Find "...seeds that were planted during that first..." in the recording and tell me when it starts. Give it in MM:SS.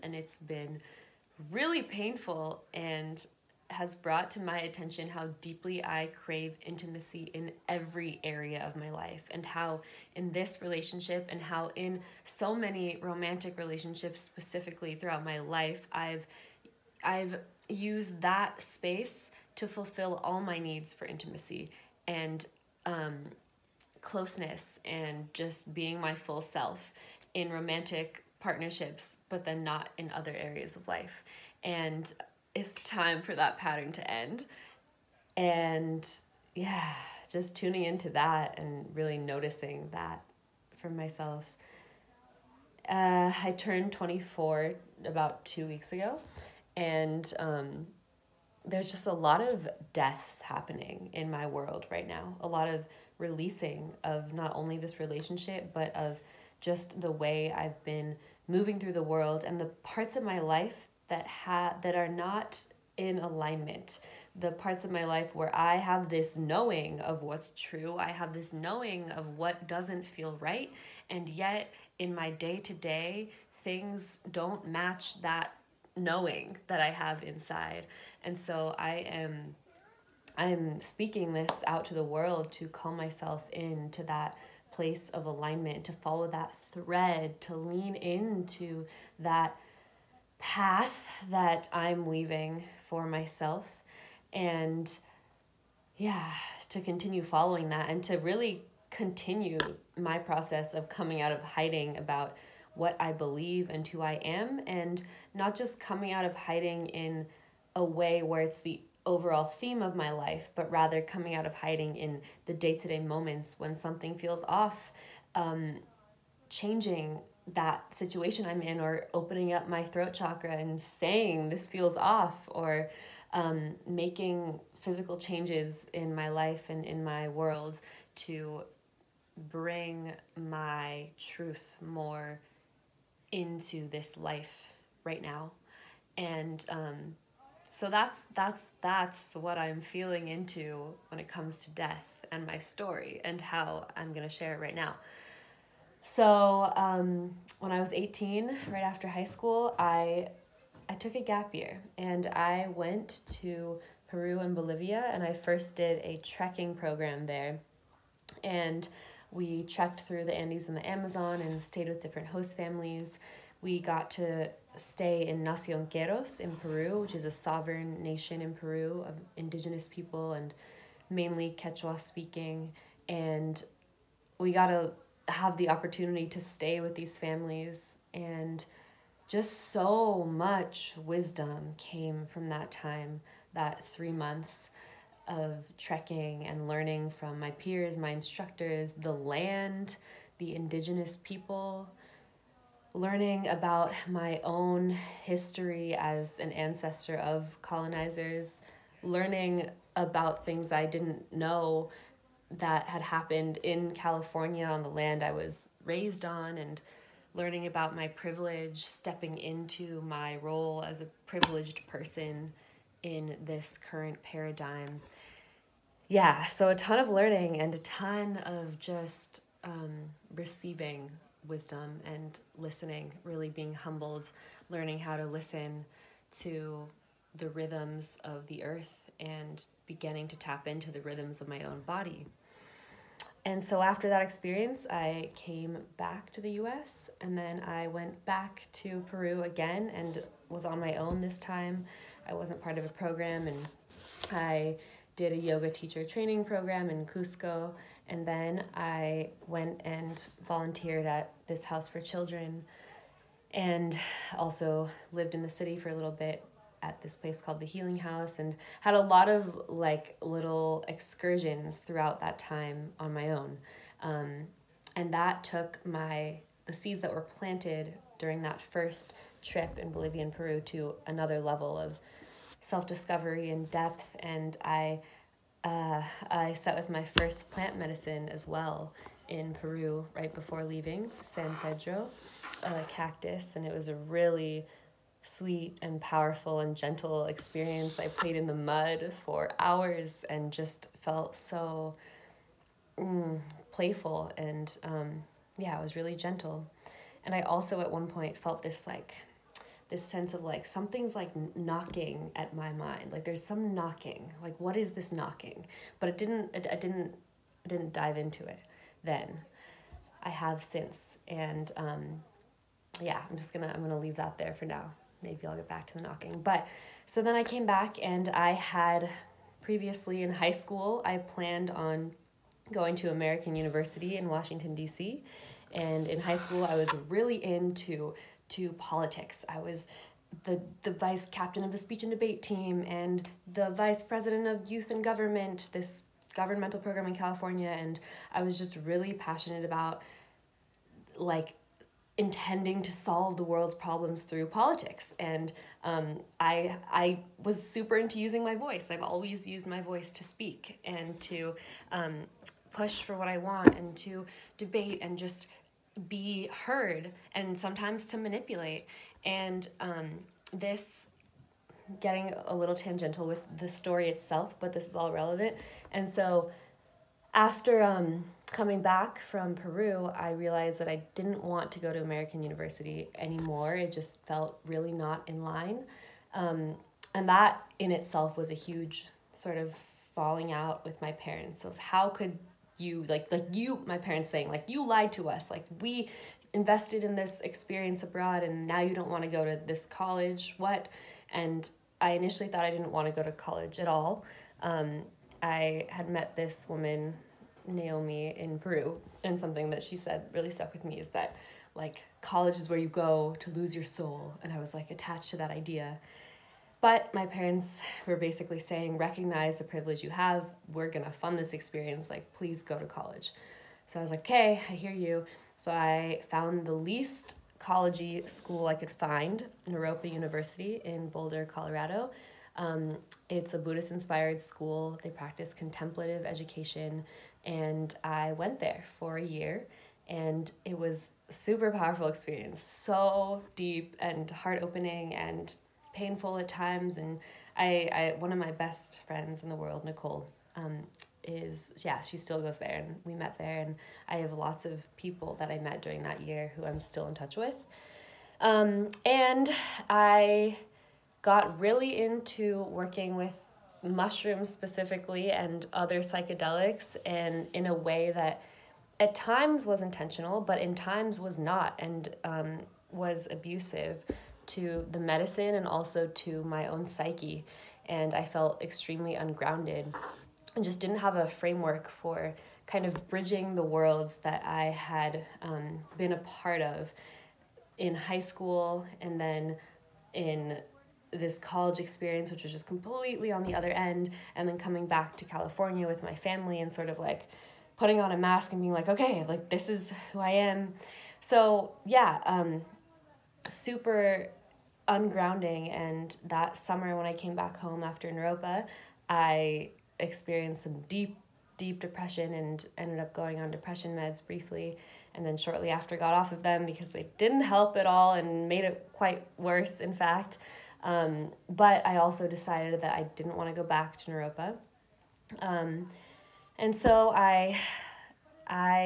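04:26.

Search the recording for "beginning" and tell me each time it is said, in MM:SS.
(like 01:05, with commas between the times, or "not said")
03:49.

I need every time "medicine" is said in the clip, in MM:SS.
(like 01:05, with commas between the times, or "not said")
04:37, 07:44.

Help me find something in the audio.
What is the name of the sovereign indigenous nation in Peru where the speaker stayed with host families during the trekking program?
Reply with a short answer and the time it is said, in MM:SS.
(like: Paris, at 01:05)
Nacion Q'eros, at 02:45.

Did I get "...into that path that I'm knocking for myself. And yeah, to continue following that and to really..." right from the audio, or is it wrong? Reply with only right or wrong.
wrong.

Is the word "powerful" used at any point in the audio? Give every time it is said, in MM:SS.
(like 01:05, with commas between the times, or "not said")
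04:46, 07:11.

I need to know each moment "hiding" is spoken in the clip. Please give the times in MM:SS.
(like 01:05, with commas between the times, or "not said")
01:41, 01:46, 01:51.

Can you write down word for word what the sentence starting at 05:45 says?
And um, I, I was super into using my voice.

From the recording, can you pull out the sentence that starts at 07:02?
Um, it's a Buddhist inspired school.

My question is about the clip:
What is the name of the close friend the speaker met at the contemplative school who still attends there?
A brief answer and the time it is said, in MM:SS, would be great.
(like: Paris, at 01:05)
Nicole, at 07:19.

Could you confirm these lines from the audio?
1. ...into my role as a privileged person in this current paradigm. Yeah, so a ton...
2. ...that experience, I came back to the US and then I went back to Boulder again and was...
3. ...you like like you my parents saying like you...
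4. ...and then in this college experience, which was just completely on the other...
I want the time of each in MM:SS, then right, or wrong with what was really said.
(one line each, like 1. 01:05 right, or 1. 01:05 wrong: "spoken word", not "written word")
1. 03:29 right
2. 03:54 wrong: "Peru", not "Boulder"
3. 06:22 right
4. 07:59 right.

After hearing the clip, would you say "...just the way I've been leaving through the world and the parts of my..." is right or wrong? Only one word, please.
wrong.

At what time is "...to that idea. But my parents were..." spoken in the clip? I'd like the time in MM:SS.
06:45.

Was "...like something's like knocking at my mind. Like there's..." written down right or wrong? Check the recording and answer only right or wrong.
right.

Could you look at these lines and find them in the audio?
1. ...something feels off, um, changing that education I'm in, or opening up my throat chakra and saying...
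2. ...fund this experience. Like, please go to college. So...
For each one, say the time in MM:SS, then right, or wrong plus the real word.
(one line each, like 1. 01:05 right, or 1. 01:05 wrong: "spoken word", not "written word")
1. 01:53 wrong: "situation", not "education"
2. 06:51 right.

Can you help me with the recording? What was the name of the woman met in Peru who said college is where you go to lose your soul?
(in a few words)
Naomi.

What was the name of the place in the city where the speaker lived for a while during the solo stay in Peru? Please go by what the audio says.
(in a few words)
the Healing House.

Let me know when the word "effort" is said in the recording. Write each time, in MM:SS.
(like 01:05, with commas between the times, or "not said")
not said.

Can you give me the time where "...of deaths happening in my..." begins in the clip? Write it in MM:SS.
00:49.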